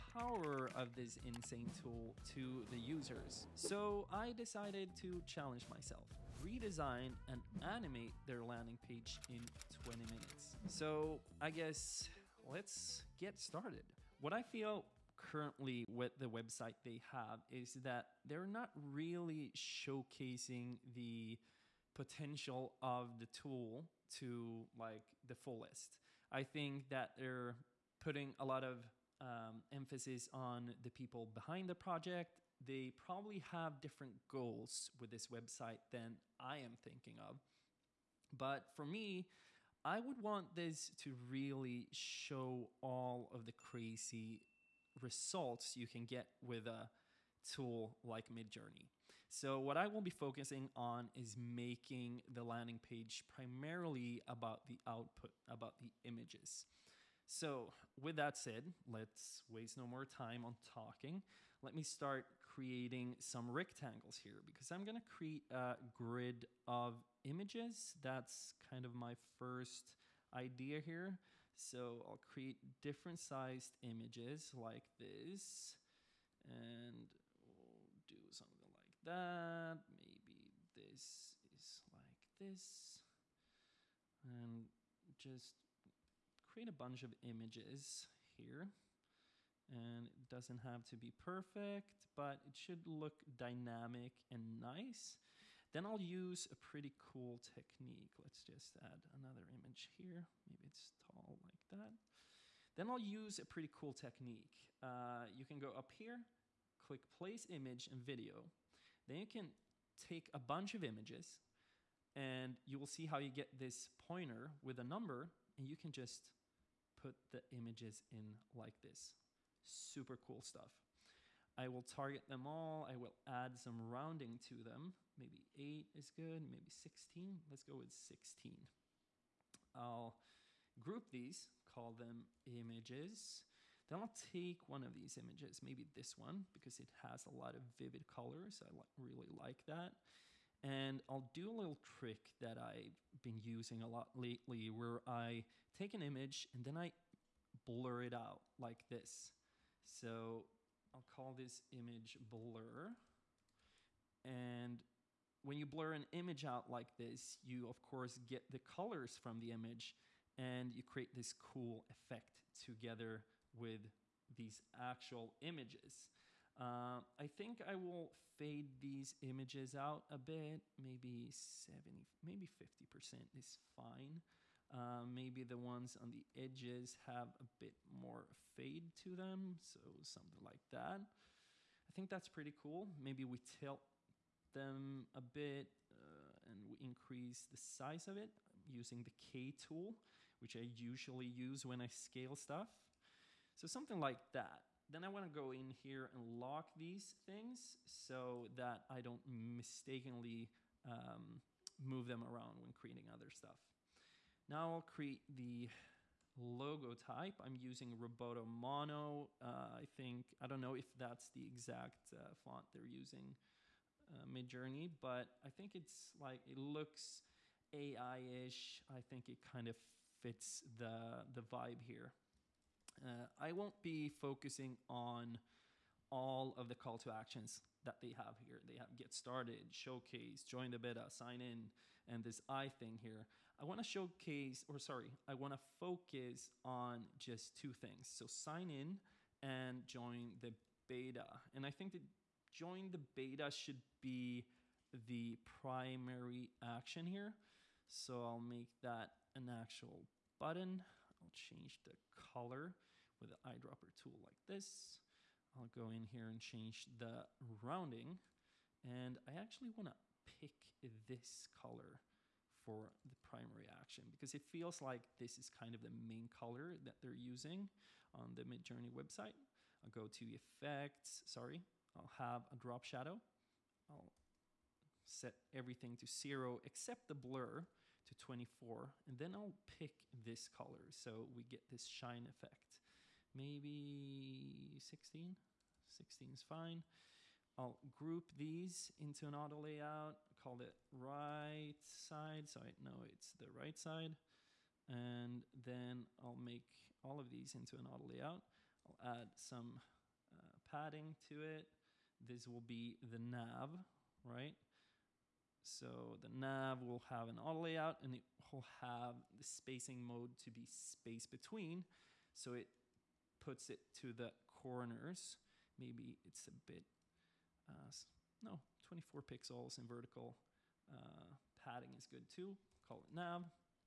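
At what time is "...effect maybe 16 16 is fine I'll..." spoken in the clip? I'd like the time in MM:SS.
04:42.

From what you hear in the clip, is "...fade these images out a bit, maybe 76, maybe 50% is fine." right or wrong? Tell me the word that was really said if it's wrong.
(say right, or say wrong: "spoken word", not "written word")
wrong: "70", not "76".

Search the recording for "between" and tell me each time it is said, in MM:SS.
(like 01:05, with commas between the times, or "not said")
05:11.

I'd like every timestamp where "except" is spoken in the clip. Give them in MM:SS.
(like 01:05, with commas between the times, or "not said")
04:36.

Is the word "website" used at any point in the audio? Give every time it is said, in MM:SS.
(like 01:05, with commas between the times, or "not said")
00:16, 00:35, 04:28.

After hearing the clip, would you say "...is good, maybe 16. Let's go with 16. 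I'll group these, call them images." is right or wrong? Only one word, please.
right.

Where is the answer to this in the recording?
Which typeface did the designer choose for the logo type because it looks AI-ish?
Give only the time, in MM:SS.
03:27.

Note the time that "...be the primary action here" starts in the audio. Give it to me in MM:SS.
04:03.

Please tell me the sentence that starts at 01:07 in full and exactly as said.
That's kind of my first idea here.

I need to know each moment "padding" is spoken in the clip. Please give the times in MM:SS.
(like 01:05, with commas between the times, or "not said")
05:00, 05:21.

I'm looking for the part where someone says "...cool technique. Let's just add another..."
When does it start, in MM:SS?
01:36.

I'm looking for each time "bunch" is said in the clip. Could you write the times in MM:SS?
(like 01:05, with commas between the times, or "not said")
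01:26, 01:50.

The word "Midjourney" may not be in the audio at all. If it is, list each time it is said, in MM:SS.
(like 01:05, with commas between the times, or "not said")
00:48, 03:34, 04:28.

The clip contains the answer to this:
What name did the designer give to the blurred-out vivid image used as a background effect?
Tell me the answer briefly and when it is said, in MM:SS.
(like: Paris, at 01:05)
image blur, at 02:31.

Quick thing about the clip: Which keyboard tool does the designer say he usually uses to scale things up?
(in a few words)
K tool.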